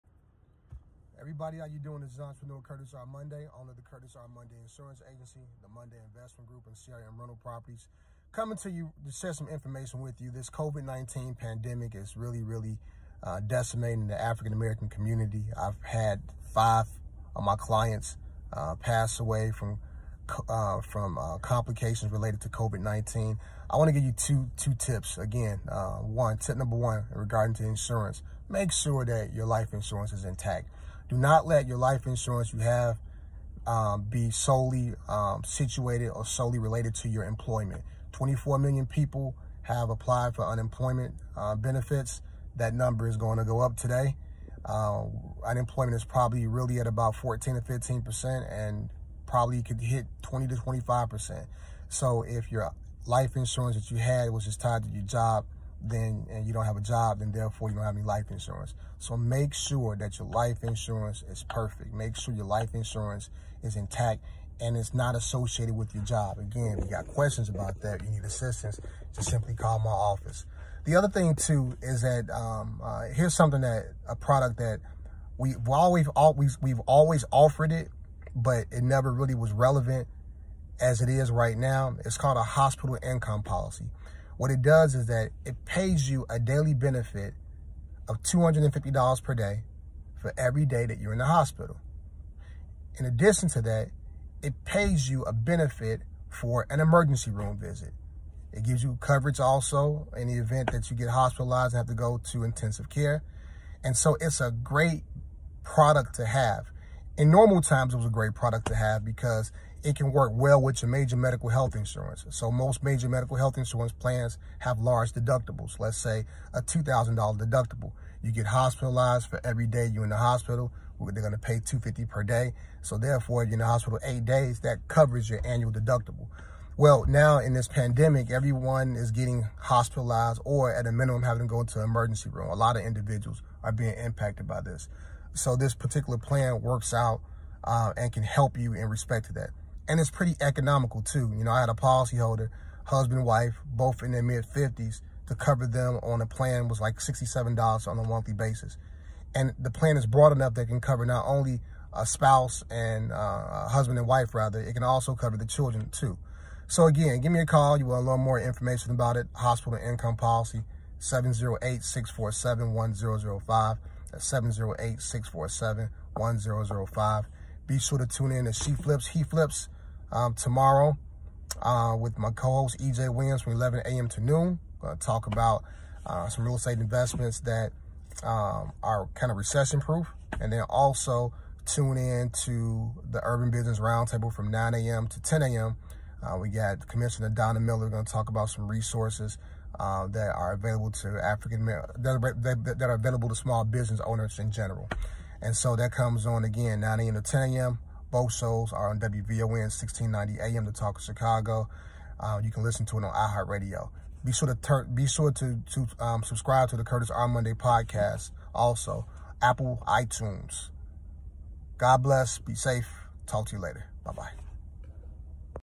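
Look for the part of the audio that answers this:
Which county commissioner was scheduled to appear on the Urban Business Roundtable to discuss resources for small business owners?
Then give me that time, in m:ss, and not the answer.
3:07.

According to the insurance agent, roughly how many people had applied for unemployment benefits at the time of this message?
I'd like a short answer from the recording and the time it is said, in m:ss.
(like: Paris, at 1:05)
24 million, at 0:38.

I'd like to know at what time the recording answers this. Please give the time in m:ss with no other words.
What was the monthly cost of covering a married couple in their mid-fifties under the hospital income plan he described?
2:26.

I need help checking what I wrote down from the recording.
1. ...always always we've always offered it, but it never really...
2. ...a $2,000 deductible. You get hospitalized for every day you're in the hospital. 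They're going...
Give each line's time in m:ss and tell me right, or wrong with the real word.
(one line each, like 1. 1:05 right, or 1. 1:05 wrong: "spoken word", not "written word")
1. 1:15 right
2. 1:56 right.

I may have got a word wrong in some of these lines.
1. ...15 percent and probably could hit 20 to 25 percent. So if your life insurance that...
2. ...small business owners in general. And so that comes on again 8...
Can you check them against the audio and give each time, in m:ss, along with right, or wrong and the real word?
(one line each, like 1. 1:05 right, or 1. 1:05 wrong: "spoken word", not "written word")
1. 0:47 right
2. 3:13 wrong: "9", not "8".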